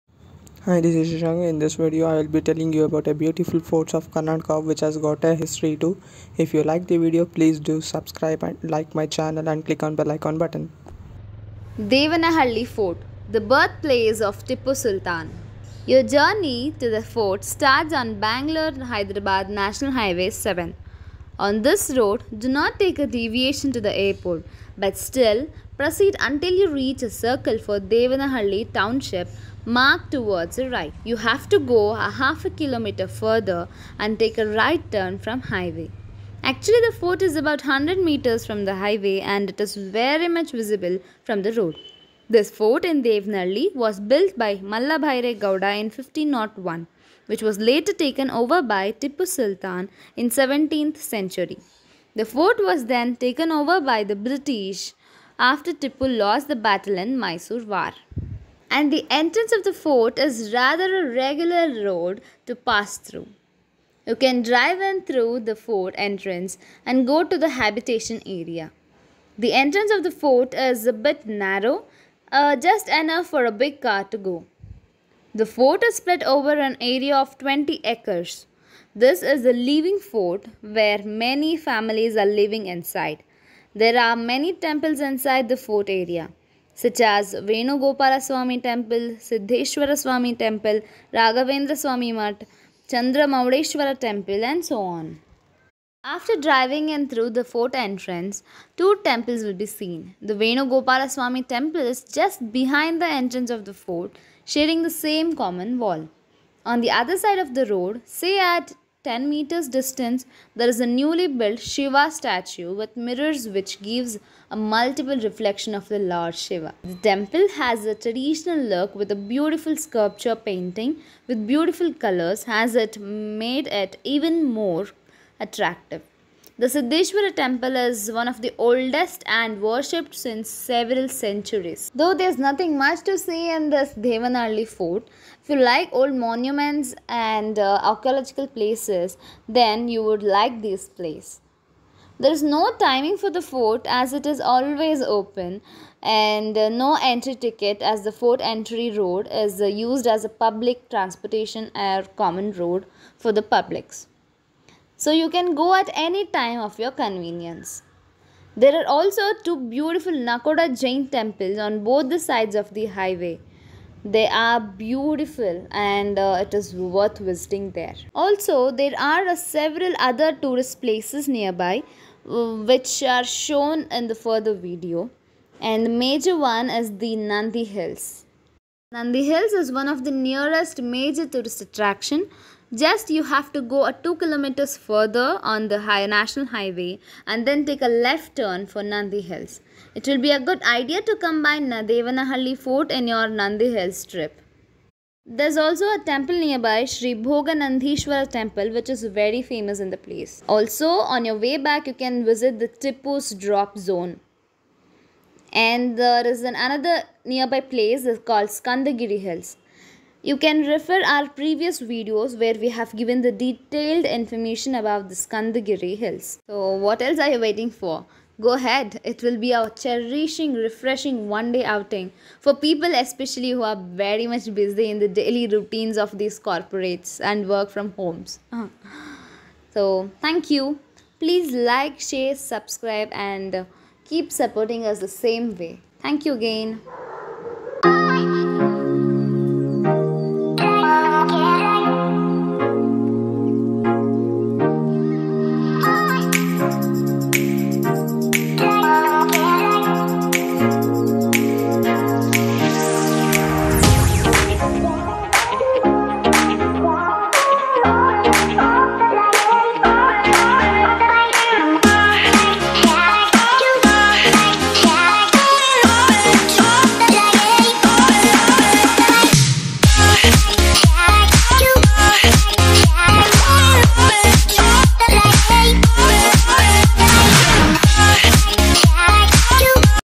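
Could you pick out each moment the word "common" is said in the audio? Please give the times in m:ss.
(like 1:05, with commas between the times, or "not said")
1:45, 2:32.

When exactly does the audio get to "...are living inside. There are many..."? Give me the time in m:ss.
1:22.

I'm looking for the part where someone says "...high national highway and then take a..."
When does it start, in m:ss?
3:05.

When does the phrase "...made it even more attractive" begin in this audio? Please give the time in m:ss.
2:02.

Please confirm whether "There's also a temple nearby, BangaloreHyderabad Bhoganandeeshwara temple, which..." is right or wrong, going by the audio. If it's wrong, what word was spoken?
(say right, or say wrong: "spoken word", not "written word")
wrong: "Sri", not "BangaloreHyderabad".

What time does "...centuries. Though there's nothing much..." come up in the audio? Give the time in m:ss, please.
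2:11.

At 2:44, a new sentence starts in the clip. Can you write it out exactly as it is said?
They are beautiful and uh, it is worth visiting there.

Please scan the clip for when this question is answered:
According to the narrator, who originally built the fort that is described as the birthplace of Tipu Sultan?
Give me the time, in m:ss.
0:44.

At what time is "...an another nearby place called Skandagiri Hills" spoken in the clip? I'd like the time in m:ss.
3:26.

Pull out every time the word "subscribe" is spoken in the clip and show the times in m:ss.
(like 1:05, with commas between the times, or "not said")
0:07, 3:52.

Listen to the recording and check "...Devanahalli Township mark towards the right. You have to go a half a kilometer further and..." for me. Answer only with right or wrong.
right.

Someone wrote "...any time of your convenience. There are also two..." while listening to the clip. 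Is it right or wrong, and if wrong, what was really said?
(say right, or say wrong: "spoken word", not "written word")
right.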